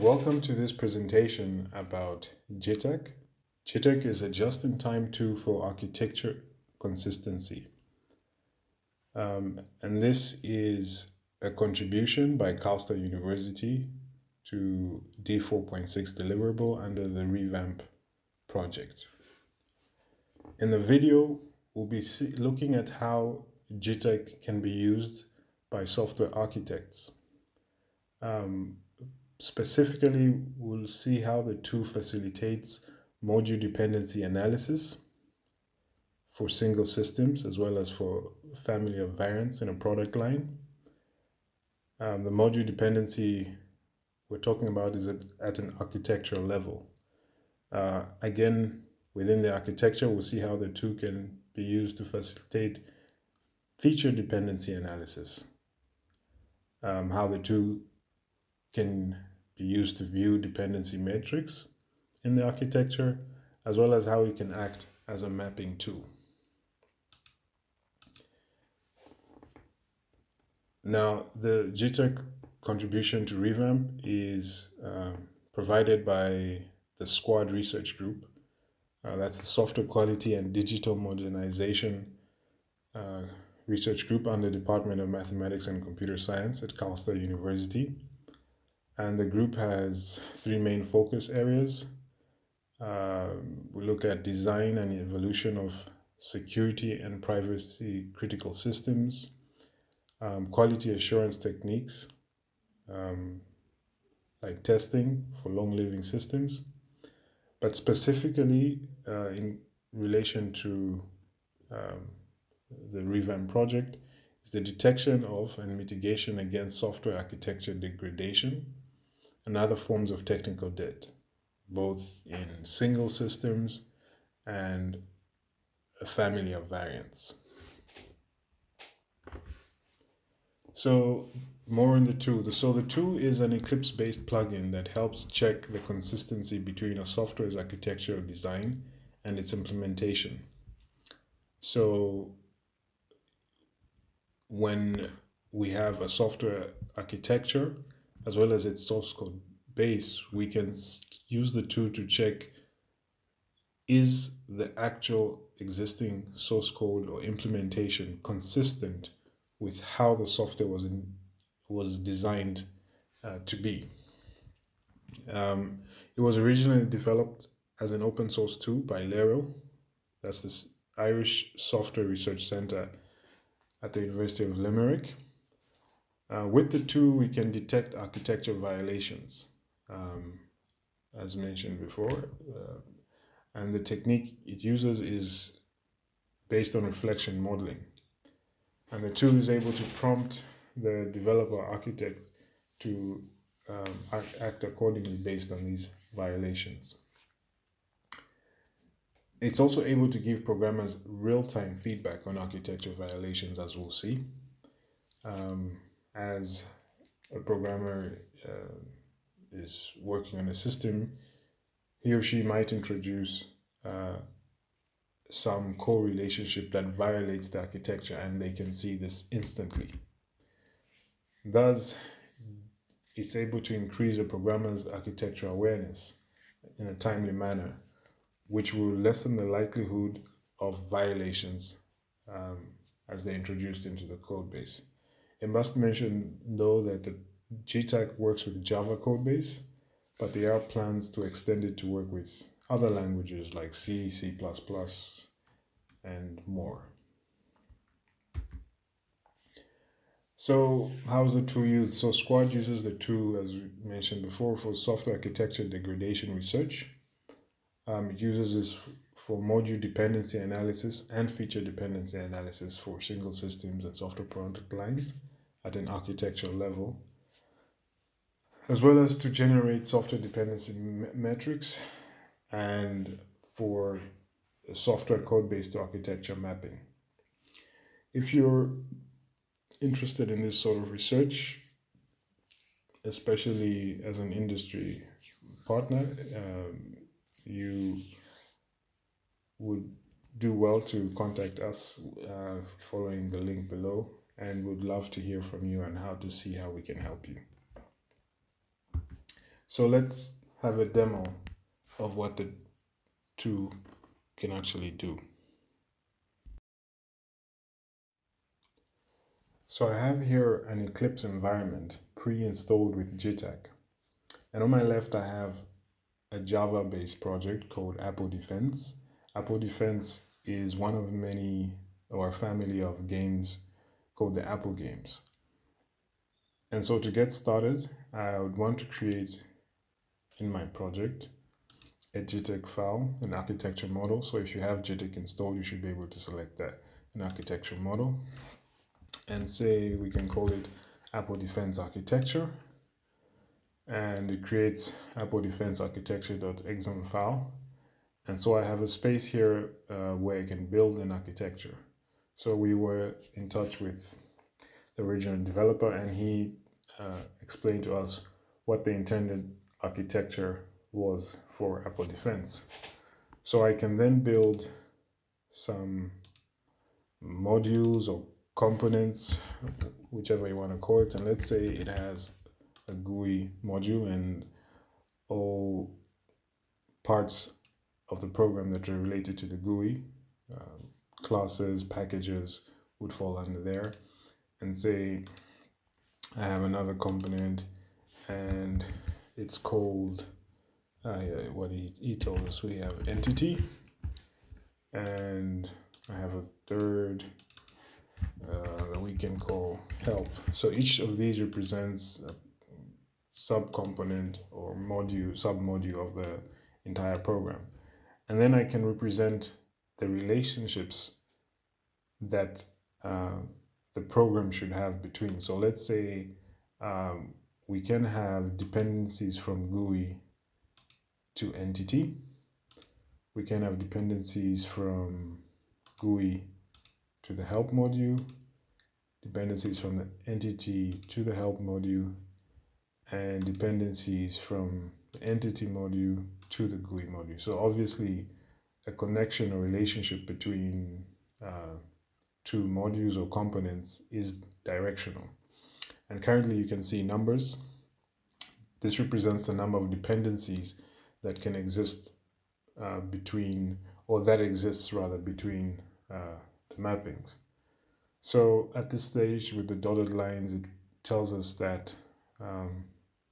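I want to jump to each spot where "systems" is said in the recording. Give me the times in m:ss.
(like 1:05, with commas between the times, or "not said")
0:36, 1:38, 1:46, 2:03, 3:30, 4:23.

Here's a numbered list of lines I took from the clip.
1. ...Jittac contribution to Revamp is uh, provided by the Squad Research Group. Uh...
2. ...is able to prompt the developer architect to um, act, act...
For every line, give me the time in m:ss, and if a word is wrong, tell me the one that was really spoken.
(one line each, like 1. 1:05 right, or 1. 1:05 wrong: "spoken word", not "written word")
1. 1:11 right
2. 3:09 right.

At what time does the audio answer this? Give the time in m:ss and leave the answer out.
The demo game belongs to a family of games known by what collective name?
5:24.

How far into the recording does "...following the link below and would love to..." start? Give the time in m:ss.
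4:52.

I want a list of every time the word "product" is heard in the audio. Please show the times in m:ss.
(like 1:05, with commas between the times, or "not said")
0:39, 4:24.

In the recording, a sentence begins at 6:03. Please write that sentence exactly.
So I can then build some modules or components, whichever you want to call it.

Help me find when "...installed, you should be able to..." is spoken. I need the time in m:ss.
5:35.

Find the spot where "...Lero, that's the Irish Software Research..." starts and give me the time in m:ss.
2:49.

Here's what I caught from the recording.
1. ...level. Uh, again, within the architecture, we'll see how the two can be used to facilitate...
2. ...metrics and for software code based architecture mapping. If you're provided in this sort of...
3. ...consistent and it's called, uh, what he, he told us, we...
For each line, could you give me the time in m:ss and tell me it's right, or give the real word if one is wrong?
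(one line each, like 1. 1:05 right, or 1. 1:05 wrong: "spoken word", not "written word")
1. 0:46 right
2. 4:31 wrong: "interested", not "provided"
3. 6:26 wrong: "component", not "consistent".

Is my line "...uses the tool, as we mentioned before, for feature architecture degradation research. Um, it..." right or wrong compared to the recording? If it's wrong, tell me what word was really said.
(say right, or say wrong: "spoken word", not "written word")
wrong: "software", not "feature".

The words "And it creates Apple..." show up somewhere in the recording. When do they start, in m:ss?
5:43.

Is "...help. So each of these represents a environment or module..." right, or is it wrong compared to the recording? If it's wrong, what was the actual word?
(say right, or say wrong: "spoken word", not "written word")
wrong: "subcomponent", not "environment".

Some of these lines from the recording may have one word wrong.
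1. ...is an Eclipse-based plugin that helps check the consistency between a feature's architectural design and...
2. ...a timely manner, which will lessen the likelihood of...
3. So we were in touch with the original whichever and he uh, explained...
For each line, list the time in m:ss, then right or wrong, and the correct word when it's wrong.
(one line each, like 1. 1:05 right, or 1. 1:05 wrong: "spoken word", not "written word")
1. 2:13 wrong: "software", not "feature"
2. 3:46 right
3. 5:52 wrong: "developer", not "whichever".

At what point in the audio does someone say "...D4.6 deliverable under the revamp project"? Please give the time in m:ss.
0:15.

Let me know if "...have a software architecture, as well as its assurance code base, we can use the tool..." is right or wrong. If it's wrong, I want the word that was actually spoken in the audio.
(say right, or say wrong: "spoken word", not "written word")
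wrong: "source", not "assurance".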